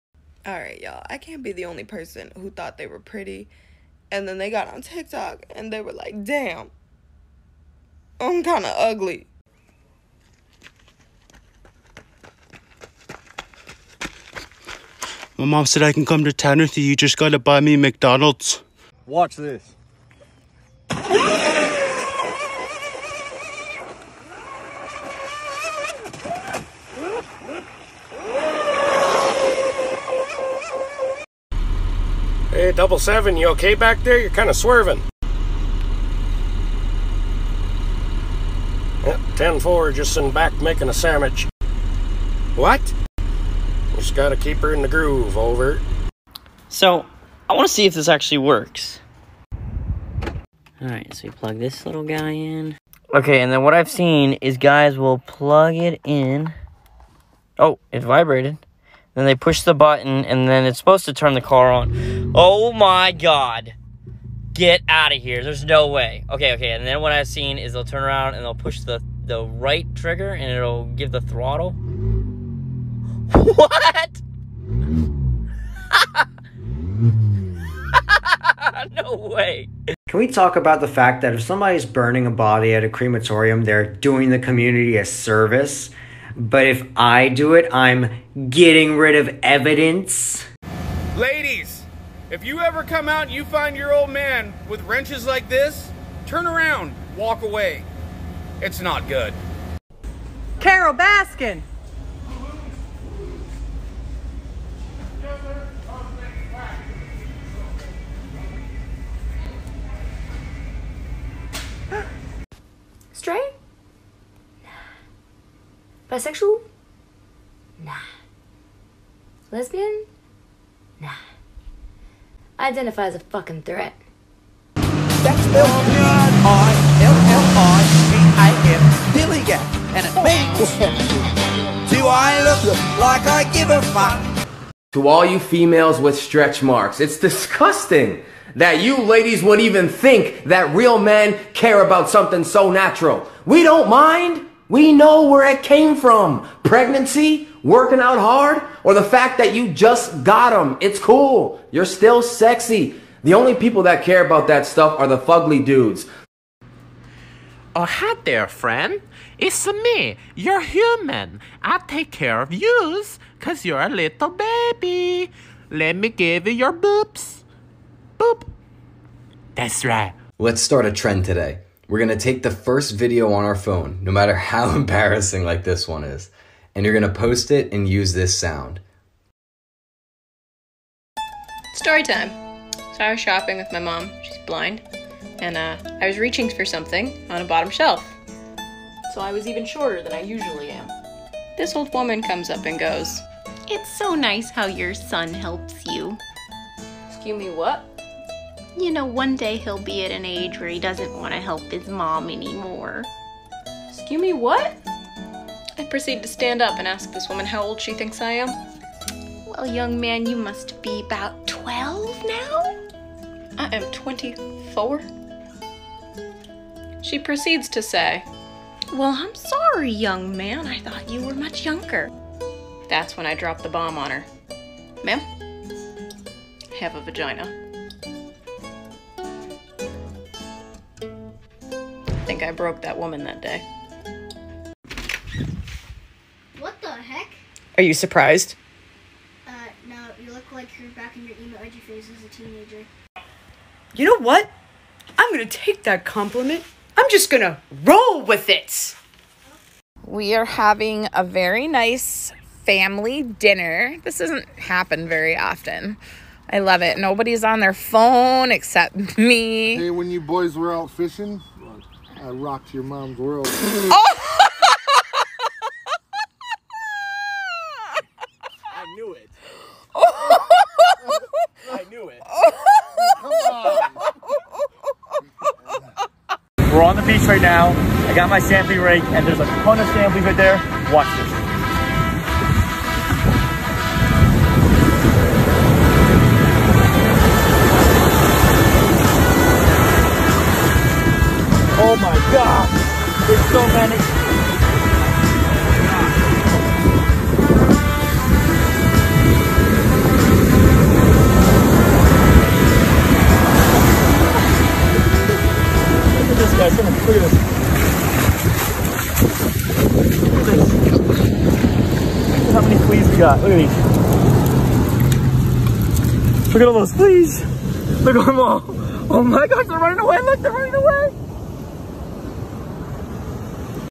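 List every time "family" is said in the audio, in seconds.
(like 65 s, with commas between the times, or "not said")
252 s.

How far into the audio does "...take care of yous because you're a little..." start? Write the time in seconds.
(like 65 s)
161 s.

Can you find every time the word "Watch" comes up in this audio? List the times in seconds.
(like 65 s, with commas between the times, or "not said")
19 s, 280 s.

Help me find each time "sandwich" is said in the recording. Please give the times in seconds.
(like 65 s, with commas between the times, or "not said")
40 s.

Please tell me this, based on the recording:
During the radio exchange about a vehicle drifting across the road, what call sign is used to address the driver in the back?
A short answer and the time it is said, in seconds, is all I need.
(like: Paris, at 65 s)
Double seven, at 32 s.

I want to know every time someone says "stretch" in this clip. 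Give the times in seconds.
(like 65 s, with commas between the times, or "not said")
136 s.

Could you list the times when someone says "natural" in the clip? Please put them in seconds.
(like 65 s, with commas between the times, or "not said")
142 s.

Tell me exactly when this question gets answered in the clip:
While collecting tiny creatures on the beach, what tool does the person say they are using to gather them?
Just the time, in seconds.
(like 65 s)
278 s.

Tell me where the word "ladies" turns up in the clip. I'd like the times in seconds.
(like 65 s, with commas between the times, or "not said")
91 s, 139 s.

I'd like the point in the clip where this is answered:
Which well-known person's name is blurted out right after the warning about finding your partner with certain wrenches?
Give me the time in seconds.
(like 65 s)
100 s.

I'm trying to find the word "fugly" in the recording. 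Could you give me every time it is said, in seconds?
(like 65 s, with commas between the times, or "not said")
155 s.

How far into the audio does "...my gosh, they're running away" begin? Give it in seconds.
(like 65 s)
319 s.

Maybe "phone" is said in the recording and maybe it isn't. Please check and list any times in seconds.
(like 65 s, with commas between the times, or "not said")
173 s, 257 s.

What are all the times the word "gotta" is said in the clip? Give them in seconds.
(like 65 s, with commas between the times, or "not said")
17 s, 44 s.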